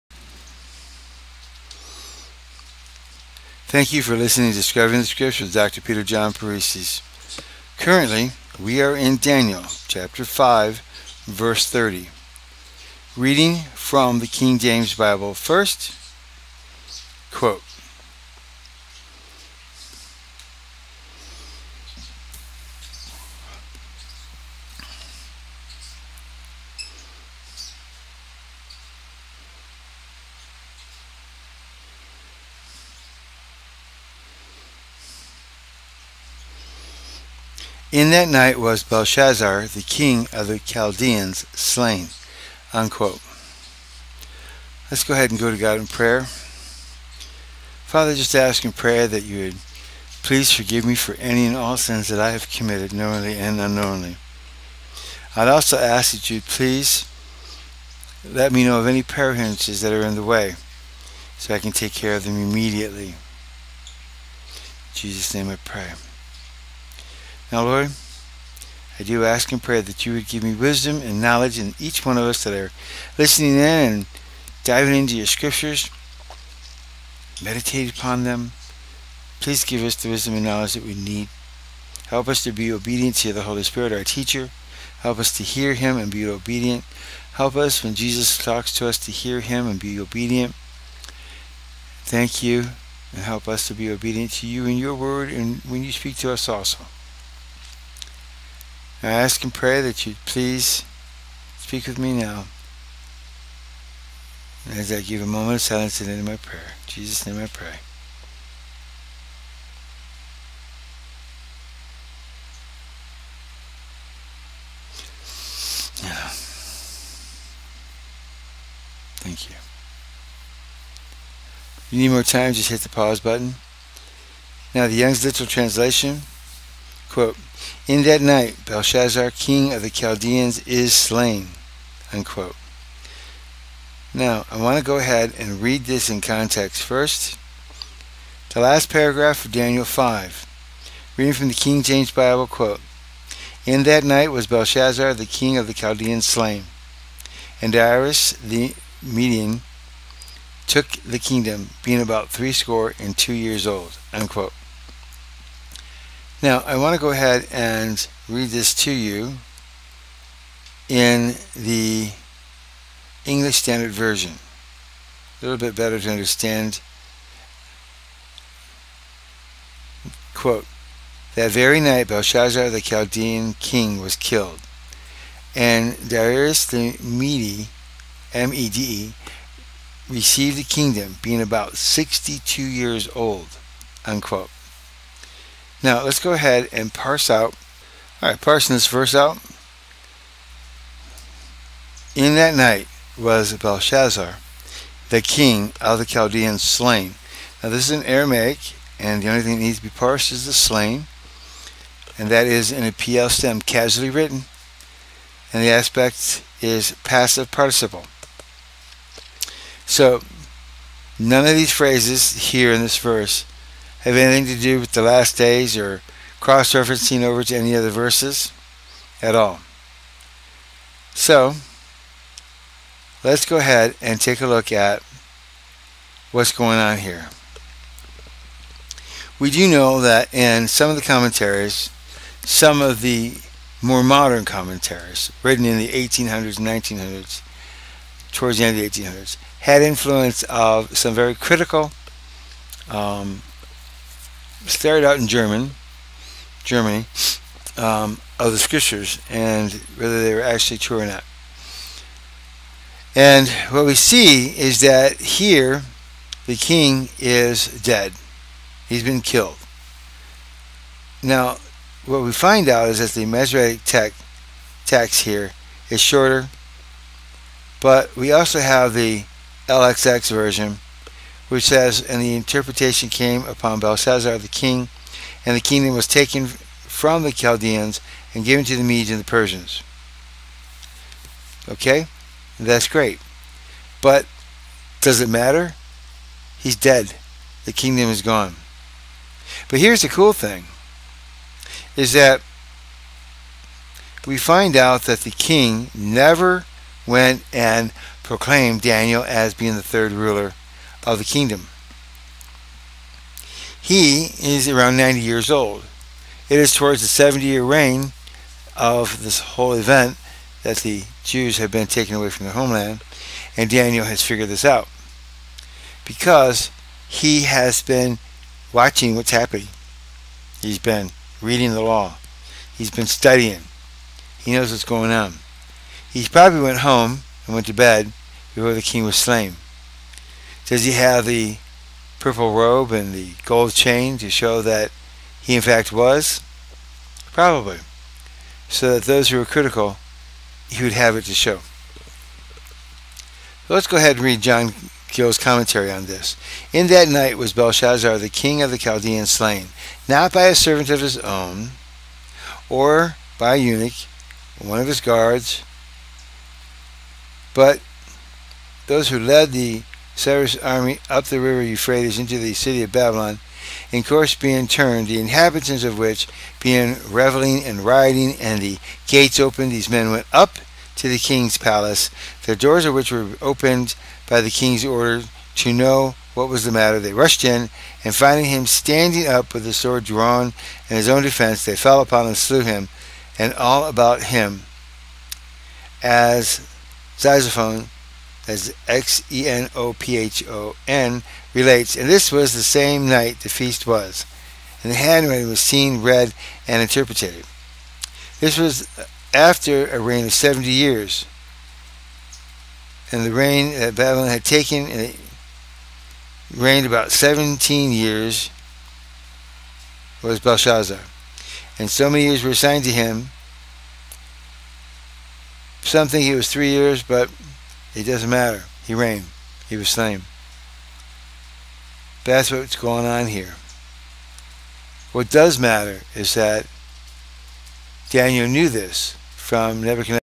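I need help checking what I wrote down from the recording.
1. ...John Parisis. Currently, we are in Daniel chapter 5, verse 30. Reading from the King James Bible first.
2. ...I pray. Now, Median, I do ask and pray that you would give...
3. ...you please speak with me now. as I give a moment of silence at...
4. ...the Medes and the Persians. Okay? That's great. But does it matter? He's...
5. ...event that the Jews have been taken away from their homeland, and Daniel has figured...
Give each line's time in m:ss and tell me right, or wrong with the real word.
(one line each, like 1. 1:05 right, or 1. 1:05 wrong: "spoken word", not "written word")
1. 0:06 right
2. 1:05 wrong: "Lord", not "Median"
3. 1:40 right
4. 4:38 right
5. 5:09 right.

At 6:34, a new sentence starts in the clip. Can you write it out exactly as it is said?
And the handwriting was seen, read, and interpreted.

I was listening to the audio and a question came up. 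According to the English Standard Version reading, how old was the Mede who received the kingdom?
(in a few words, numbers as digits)
62.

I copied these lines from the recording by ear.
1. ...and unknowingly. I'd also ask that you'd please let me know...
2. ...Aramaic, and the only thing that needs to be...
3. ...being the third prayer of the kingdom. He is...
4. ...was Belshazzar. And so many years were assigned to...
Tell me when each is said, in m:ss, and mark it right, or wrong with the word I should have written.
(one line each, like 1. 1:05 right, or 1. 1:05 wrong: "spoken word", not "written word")
1. 0:53 right
2. 3:18 right
3. 4:59 wrong: "ruler", not "prayer"
4. 6:50 right.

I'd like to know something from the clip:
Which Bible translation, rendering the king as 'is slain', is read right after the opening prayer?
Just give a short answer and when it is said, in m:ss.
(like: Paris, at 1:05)
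Young's Literal Translation, at 2:04.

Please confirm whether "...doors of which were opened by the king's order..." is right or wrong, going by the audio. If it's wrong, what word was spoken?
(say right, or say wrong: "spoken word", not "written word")
right.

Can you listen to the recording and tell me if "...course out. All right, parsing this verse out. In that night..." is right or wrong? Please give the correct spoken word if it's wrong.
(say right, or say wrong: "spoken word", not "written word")
wrong: "parse", not "course".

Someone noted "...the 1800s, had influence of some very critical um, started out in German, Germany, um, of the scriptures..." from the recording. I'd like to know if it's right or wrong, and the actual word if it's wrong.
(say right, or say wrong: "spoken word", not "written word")
right.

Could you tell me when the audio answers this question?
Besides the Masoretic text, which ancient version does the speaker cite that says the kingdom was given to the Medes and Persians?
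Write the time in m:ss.
4:29.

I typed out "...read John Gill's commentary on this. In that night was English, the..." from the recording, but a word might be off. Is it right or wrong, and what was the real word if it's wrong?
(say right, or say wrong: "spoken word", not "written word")
wrong: "Belshazzar", not "English".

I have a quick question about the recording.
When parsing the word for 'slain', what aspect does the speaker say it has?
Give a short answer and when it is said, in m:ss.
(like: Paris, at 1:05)
passive participle, at 3:27.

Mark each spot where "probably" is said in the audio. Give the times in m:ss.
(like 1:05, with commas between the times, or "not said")
5:26, 5:37.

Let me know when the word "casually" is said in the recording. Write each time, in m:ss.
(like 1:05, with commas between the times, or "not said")
3:23.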